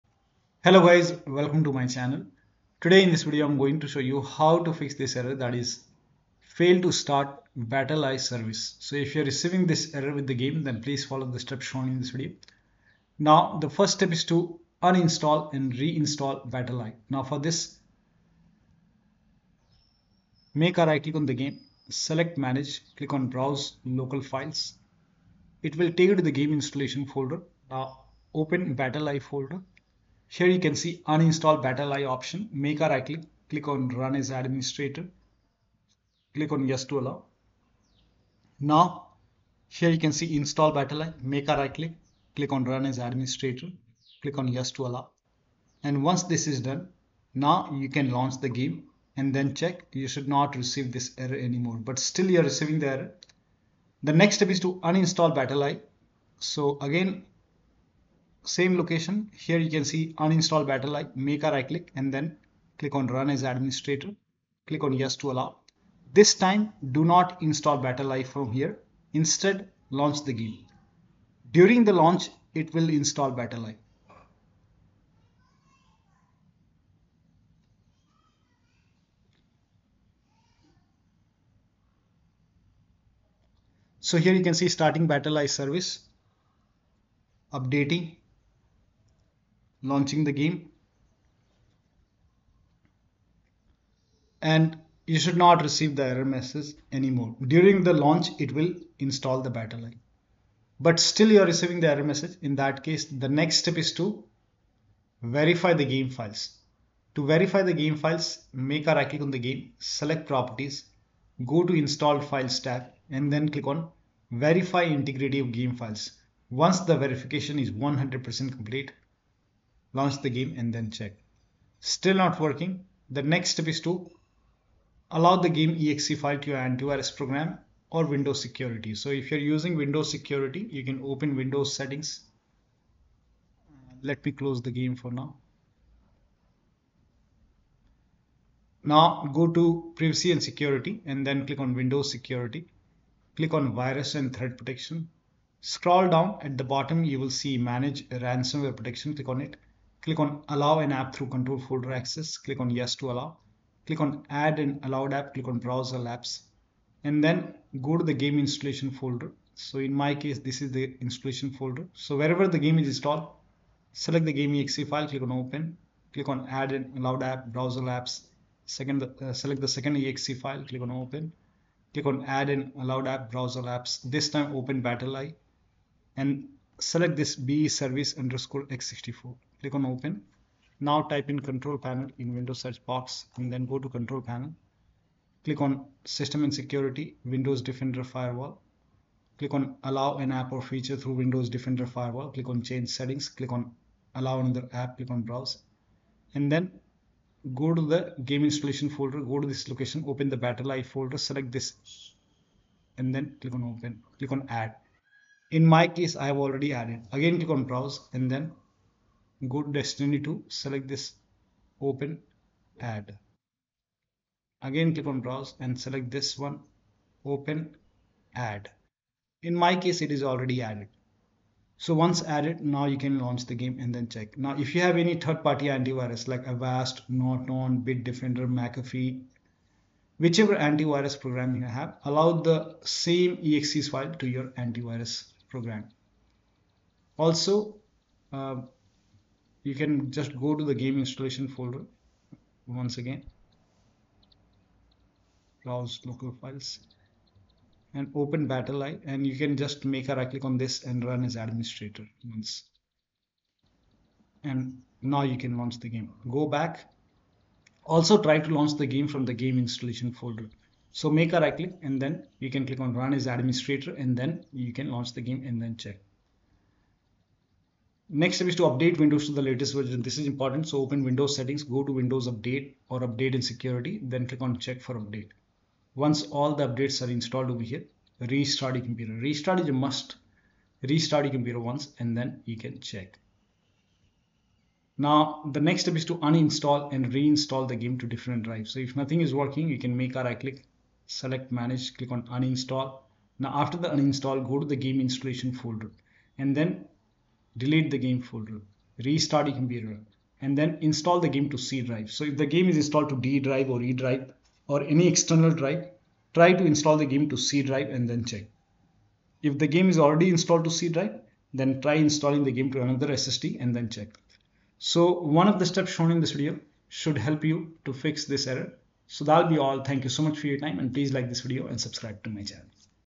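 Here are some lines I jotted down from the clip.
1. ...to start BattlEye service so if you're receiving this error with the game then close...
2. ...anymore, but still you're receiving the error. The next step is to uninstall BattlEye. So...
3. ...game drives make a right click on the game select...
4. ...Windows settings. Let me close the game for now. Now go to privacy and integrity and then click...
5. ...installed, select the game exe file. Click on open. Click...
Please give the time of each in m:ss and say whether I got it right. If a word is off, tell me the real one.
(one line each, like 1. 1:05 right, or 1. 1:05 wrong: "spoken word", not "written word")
1. 0:06 wrong: "please", not "close"
2. 0:51 right
3. 1:47 wrong: "files", not "drives"
4. 2:11 wrong: "security", not "integrity"
5. 2:42 right.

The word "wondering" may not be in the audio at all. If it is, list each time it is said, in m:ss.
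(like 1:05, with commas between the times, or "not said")
not said.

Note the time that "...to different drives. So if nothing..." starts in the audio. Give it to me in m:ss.
4:47.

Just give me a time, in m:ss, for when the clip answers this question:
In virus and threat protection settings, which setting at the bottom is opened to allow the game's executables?
2:27.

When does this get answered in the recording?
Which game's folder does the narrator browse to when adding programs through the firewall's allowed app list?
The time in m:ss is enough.
3:29.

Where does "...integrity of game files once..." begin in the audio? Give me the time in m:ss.
1:54.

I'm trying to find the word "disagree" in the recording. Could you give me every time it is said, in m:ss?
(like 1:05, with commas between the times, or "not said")
not said.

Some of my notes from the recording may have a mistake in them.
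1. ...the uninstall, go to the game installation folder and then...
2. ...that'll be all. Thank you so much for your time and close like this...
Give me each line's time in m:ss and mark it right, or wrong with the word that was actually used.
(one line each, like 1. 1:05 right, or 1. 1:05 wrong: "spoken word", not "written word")
1. 4:53 right
2. 5:19 wrong: "please", not "close".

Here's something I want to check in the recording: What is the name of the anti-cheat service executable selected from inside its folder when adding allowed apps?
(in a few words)
BE service x64.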